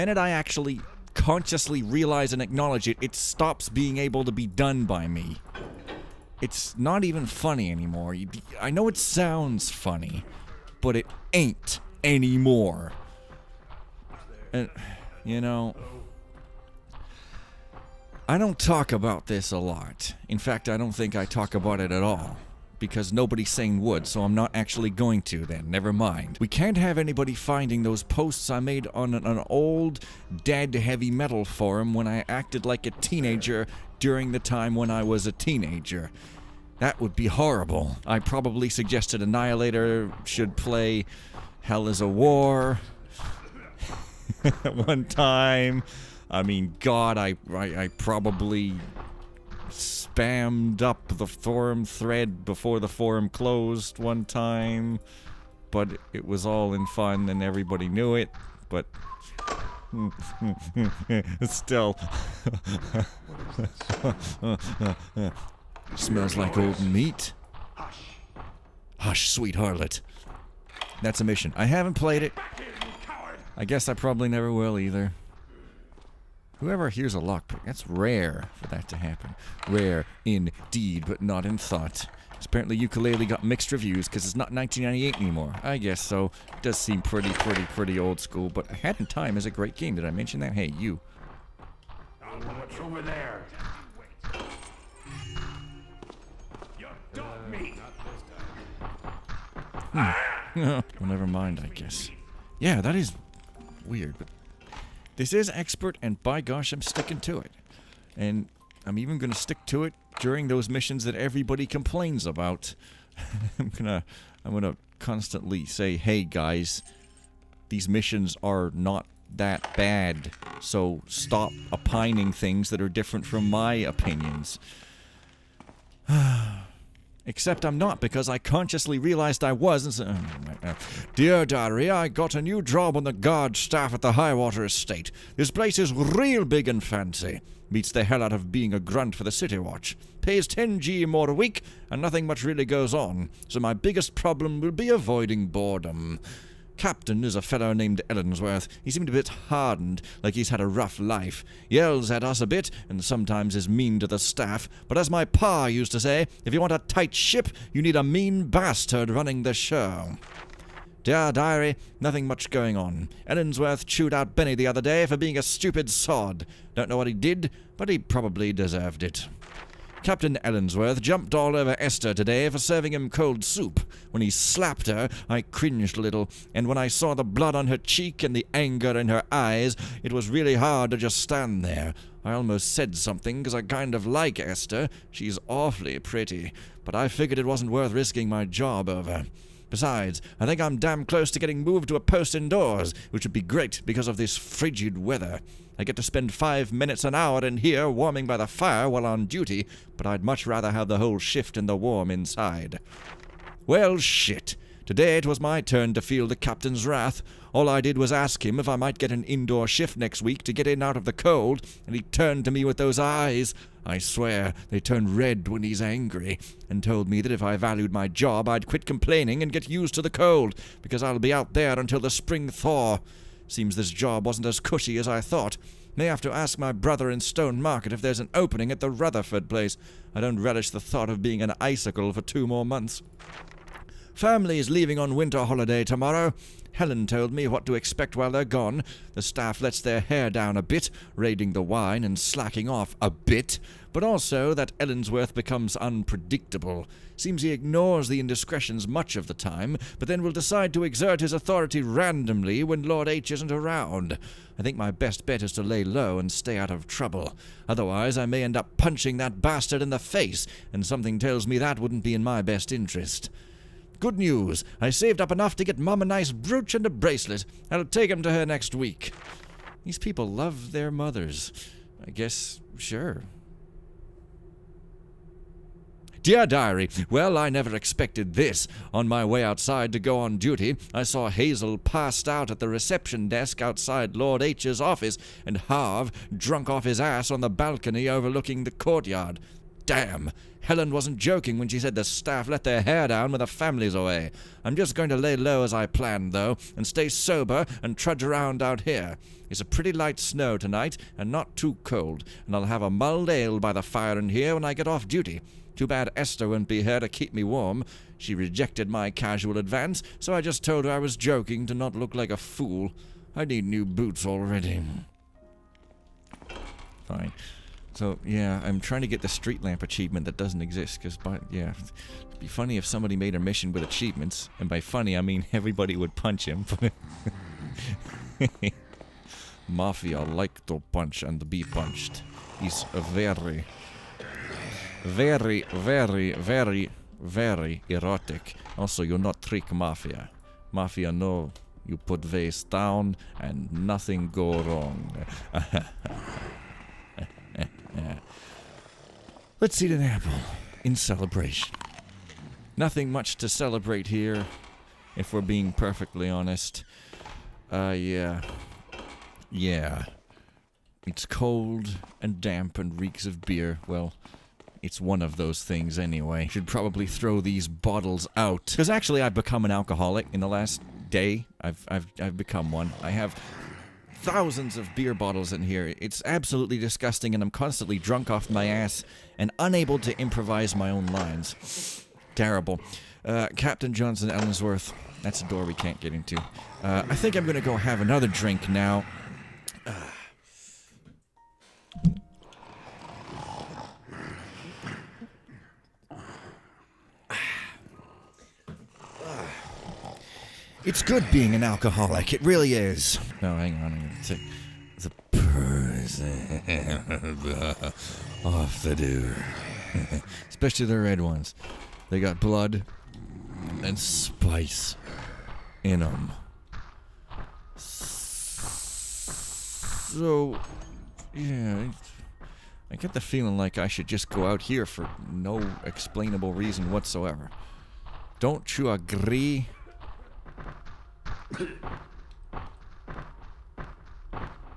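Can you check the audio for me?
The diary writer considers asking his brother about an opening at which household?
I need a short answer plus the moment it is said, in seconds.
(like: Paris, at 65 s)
Rutherford place, at 228 s.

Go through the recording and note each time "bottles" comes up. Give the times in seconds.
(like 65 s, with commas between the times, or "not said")
367 s, 375 s.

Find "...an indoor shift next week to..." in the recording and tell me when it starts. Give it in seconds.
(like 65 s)
209 s.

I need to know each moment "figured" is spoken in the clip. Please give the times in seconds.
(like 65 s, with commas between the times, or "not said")
187 s.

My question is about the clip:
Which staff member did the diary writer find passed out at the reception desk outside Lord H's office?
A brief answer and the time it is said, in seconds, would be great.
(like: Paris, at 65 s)
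Hazel, at 281 s.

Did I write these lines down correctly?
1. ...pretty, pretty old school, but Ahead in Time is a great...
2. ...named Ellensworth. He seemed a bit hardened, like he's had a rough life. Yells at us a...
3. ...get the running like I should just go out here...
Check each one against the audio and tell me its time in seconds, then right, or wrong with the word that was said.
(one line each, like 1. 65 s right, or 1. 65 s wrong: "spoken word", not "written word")
1. 87 s right
2. 147 s right
3. 422 s wrong: "feeling", not "running".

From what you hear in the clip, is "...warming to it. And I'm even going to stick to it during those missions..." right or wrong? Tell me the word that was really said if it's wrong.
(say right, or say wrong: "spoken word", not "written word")
wrong: "sticking", not "warming".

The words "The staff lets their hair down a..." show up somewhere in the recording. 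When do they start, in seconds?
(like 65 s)
239 s.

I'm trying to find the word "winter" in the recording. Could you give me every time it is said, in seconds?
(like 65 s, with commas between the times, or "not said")
235 s.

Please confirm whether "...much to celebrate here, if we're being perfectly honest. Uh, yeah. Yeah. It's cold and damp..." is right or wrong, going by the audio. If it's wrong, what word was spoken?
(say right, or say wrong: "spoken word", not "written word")
right.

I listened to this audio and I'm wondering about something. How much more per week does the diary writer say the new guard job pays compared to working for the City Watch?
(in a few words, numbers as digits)
10g.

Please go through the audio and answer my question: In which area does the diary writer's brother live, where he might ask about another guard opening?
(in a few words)
Stone Market.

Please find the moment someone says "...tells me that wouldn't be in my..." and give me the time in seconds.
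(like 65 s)
261 s.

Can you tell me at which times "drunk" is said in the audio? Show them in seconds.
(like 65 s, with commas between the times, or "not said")
286 s, 377 s.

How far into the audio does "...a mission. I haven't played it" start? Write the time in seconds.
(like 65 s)
71 s.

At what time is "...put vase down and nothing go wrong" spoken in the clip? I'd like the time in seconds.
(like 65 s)
341 s.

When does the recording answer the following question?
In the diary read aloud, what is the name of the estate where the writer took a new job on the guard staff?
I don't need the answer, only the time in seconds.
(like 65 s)
134 s.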